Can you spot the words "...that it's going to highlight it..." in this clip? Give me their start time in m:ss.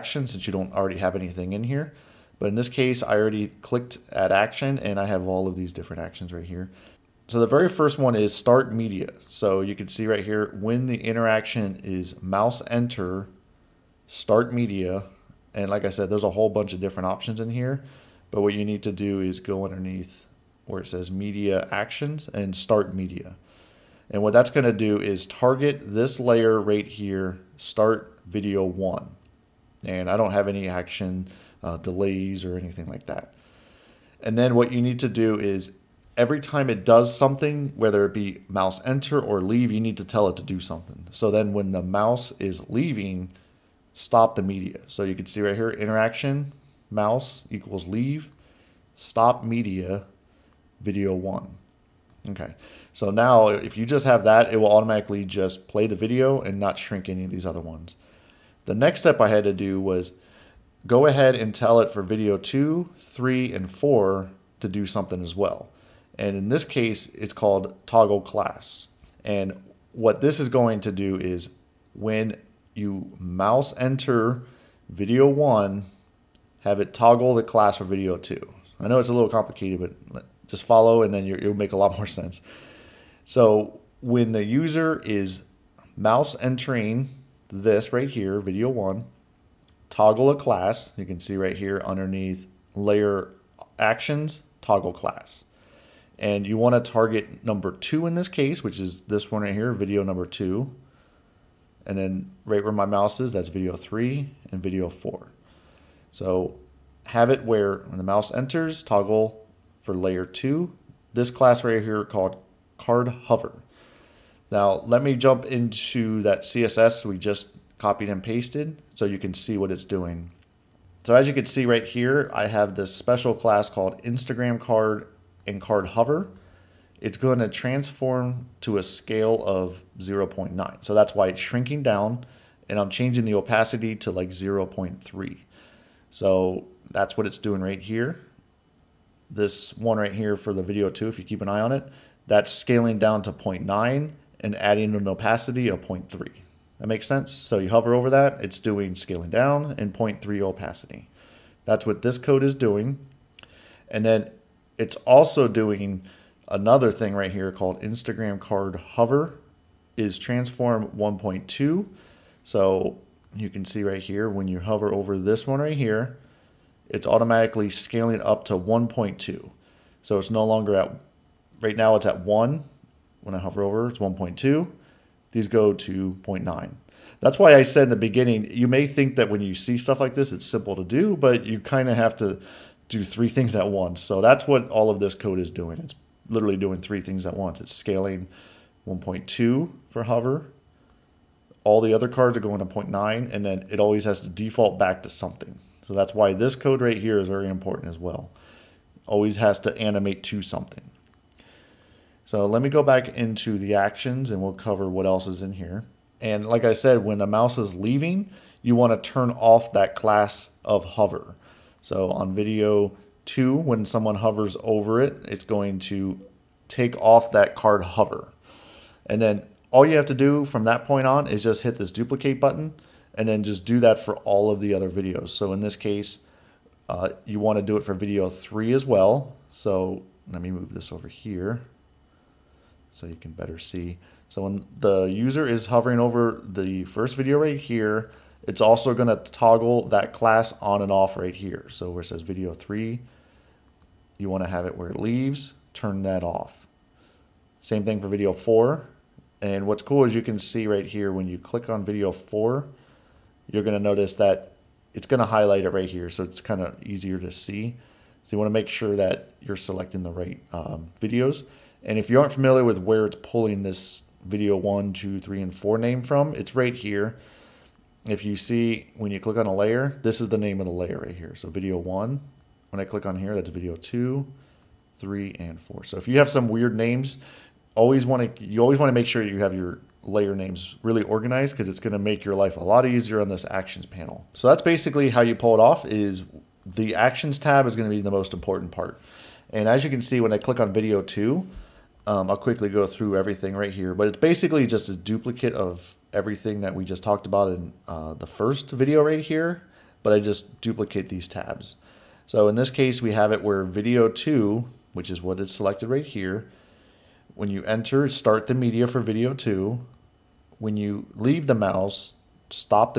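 4:14.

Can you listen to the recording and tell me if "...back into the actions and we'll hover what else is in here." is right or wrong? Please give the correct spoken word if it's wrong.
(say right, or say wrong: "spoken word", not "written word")
wrong: "cover", not "hover".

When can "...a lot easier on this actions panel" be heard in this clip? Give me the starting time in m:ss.
4:42.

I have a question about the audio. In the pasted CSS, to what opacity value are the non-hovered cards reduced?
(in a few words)
0.3.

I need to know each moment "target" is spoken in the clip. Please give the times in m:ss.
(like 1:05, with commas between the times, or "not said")
0:25, 1:36.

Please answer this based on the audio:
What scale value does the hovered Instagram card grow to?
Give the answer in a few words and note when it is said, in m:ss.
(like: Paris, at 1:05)
1.2, at 2:40.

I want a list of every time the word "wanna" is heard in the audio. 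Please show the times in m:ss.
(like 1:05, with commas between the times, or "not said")
1:36.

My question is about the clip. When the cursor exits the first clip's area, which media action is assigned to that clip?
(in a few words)
Stop media.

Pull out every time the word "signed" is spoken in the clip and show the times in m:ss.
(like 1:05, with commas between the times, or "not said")
not said.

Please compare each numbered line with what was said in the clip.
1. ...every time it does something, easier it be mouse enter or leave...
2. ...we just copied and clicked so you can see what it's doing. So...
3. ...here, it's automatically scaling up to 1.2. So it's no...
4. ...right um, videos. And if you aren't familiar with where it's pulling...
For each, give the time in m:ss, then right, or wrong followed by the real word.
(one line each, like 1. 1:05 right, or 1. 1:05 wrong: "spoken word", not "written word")
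1. 0:36 wrong: "whether", not "easier"
2. 1:57 wrong: "pasted", not "clicked"
3. 2:45 right
4. 4:20 right.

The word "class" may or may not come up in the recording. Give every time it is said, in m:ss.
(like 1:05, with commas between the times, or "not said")
1:08, 1:17, 1:30, 1:34, 1:51, 2:03, 3:29, 4:00.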